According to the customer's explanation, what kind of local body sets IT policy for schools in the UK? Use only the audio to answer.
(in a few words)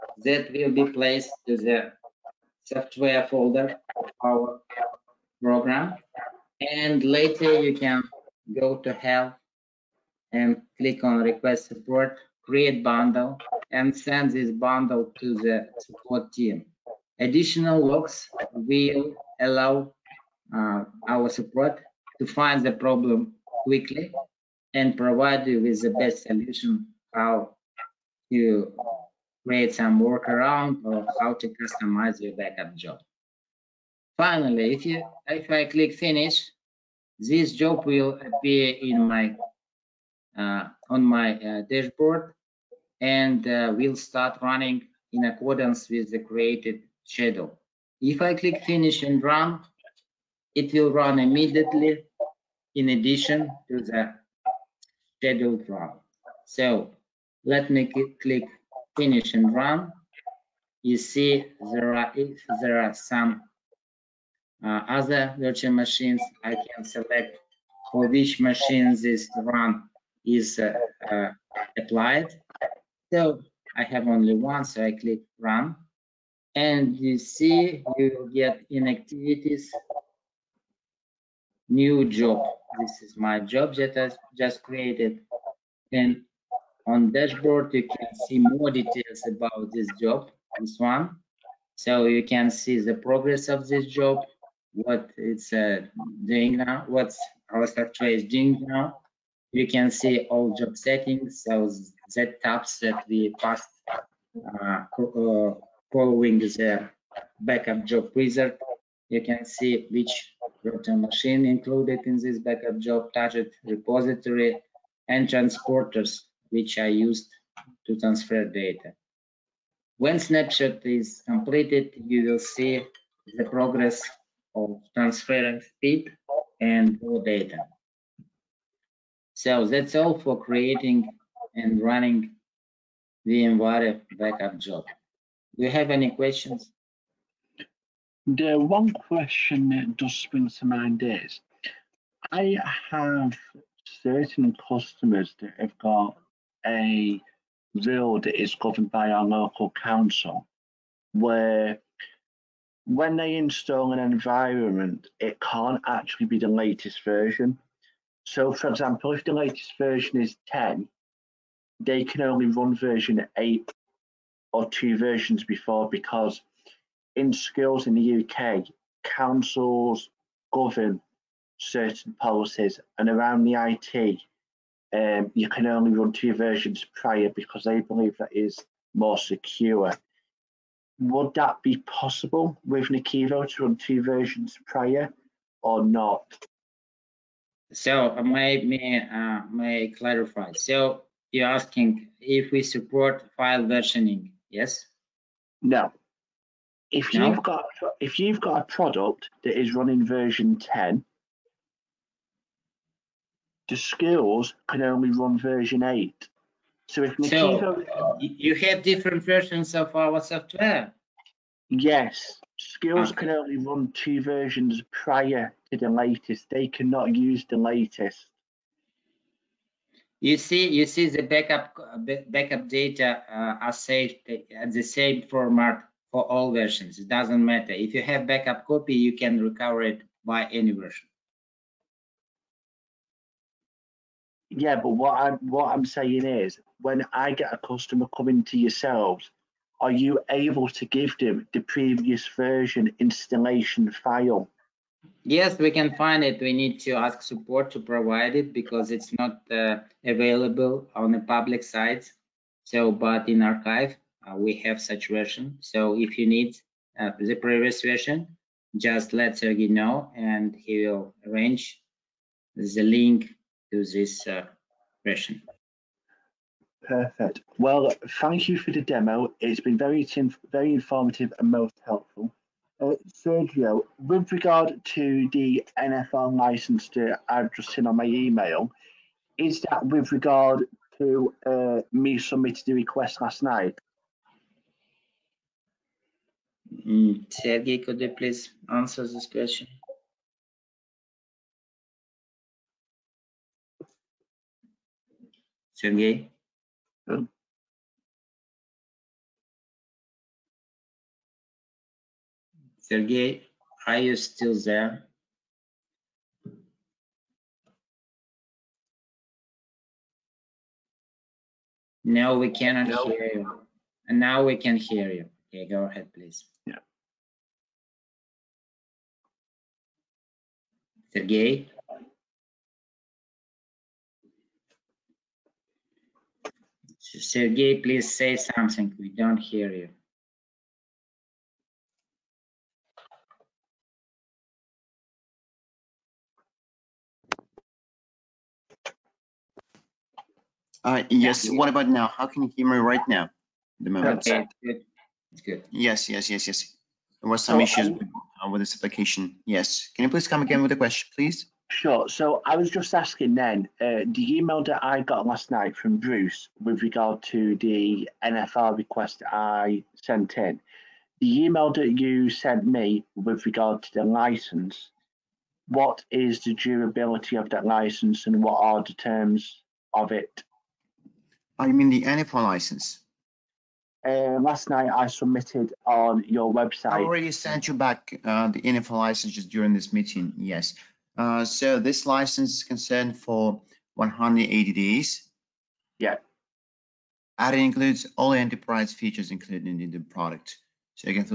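Councils.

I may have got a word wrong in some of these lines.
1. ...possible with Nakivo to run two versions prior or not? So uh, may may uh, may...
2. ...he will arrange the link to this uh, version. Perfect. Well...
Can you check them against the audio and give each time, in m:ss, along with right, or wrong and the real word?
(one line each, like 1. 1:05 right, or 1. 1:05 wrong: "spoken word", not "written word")
1. 3:01 right
2. 4:20 right.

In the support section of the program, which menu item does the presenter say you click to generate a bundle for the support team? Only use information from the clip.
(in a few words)
Request support.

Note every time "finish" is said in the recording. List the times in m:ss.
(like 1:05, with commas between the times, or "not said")
0:35, 0:48, 0:58.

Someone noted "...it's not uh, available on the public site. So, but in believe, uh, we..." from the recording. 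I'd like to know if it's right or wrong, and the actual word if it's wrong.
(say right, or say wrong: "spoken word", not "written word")
wrong: "archive", not "believe".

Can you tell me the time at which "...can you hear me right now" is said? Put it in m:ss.
5:42.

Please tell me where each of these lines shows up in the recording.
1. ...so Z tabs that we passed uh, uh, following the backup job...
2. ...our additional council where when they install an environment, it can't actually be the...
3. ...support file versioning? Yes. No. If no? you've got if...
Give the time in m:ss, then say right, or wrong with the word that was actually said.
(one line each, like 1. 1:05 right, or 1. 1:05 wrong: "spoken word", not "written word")
1. 1:41 right
2. 2:29 wrong: "local", not "additional"
3. 3:12 right.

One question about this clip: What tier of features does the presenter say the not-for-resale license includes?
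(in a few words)
Enterprise features.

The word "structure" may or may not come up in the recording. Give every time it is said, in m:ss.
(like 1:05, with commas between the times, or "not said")
1:37.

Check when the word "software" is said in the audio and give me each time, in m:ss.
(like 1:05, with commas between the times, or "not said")
0:02, 3:30.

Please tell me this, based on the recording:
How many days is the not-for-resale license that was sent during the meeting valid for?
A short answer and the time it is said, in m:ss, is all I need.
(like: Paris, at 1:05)
180 days, at 6:23.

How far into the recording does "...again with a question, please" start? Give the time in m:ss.
5:50.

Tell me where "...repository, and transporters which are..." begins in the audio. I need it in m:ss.
1:53.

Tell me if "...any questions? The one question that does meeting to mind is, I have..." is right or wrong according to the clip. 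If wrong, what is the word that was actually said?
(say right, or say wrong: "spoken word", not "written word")
wrong: "spring", not "meeting".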